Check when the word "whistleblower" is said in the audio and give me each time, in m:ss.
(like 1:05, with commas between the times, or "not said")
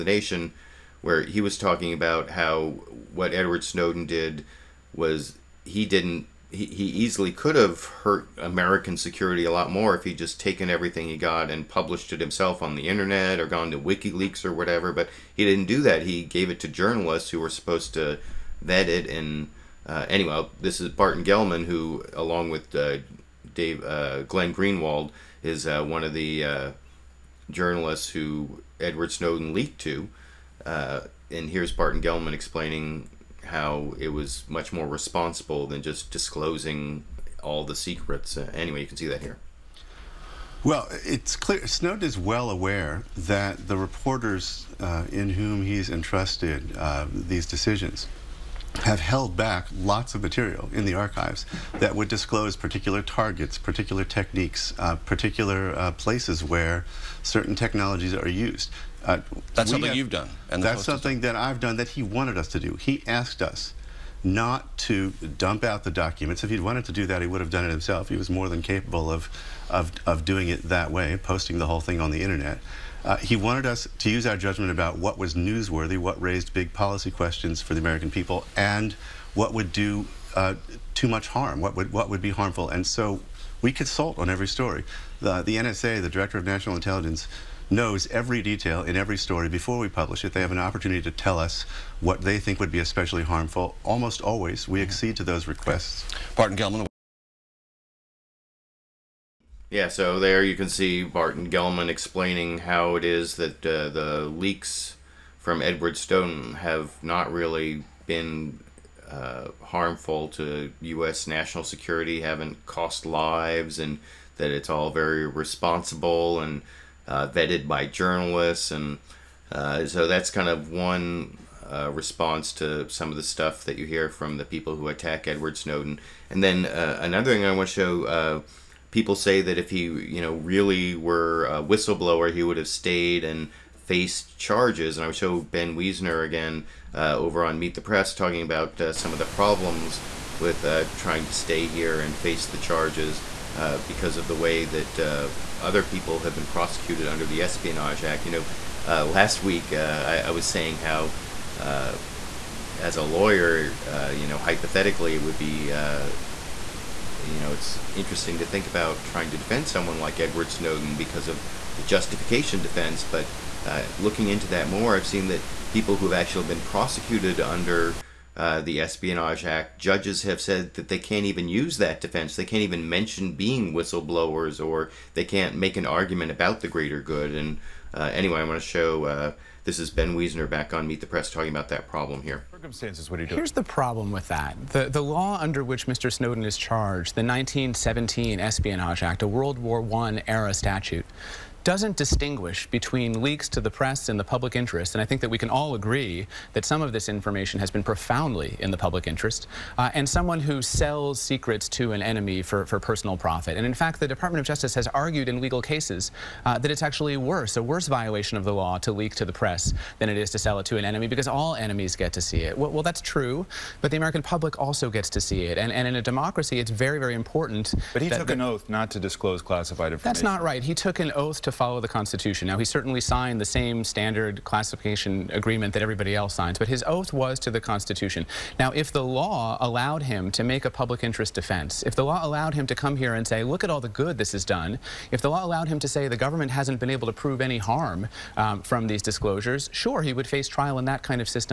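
2:11, 2:53.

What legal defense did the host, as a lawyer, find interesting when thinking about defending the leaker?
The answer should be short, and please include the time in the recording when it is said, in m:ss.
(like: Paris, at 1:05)
justification defense, at 2:41.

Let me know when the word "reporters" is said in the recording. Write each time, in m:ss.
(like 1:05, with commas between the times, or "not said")
0:43.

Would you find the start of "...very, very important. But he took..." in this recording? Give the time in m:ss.
3:36.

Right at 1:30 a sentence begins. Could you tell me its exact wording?
They have an opportunity to tell us what they think would be especially harmful.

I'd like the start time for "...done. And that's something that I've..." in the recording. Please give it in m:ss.
1:00.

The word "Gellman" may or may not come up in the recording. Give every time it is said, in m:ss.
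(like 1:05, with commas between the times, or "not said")
0:21, 0:31, 1:36, 1:41.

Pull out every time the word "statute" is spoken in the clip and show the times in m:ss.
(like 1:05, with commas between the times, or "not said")
3:10.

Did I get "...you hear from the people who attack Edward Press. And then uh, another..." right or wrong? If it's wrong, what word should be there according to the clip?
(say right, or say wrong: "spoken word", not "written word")
wrong: "Snowden", not "Press".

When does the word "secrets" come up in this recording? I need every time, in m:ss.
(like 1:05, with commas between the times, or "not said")
0:37, 3:21.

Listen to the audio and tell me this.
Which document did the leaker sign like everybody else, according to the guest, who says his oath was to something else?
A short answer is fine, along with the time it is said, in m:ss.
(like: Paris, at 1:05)
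standard classification agreement, at 3:43.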